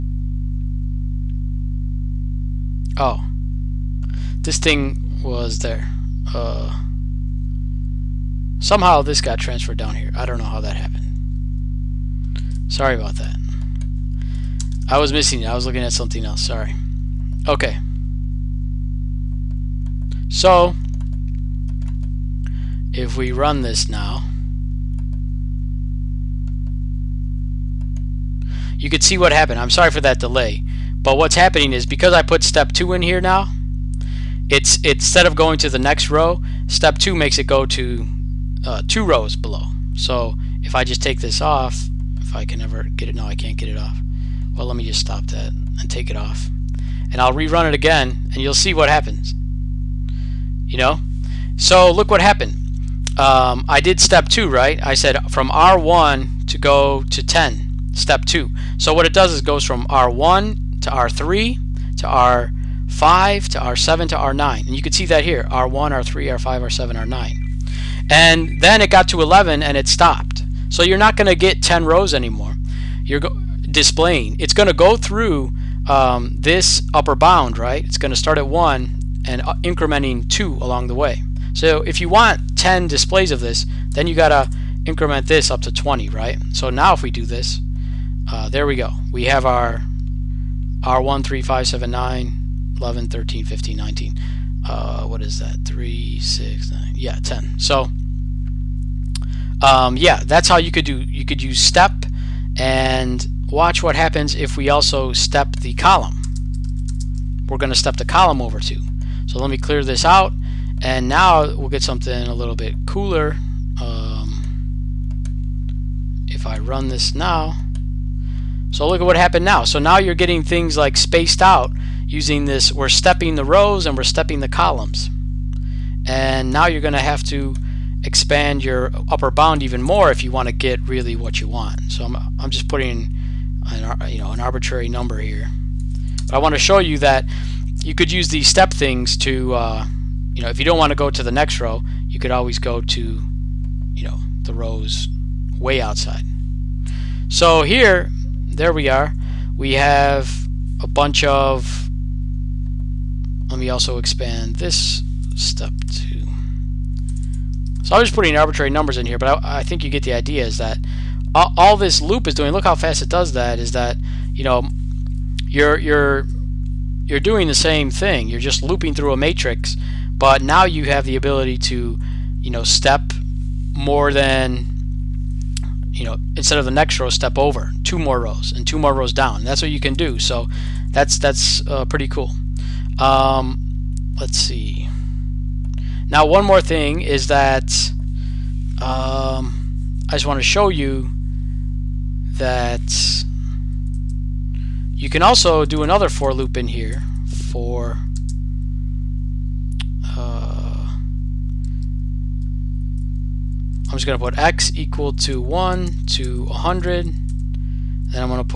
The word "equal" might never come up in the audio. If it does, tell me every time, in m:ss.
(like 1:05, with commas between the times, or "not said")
3:24.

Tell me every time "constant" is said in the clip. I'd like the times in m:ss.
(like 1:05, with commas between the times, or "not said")
not said.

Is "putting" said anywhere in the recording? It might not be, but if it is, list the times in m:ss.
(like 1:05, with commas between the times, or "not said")
2:12, 2:38.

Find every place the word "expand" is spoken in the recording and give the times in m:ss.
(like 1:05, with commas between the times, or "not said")
2:08, 2:33.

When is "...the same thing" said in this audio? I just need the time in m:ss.
2:47.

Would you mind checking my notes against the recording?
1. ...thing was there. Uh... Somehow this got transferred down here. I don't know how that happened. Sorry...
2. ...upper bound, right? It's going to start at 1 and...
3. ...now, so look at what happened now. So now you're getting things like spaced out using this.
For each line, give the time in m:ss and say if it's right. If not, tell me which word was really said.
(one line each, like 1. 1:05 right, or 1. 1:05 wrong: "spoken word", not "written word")
1. 0:04 right
2. 1:16 right
3. 1:57 right.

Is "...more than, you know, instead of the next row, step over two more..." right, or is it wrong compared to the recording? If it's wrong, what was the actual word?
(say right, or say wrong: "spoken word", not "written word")
right.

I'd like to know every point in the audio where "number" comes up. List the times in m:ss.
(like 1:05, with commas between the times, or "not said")
2:14, 2:38.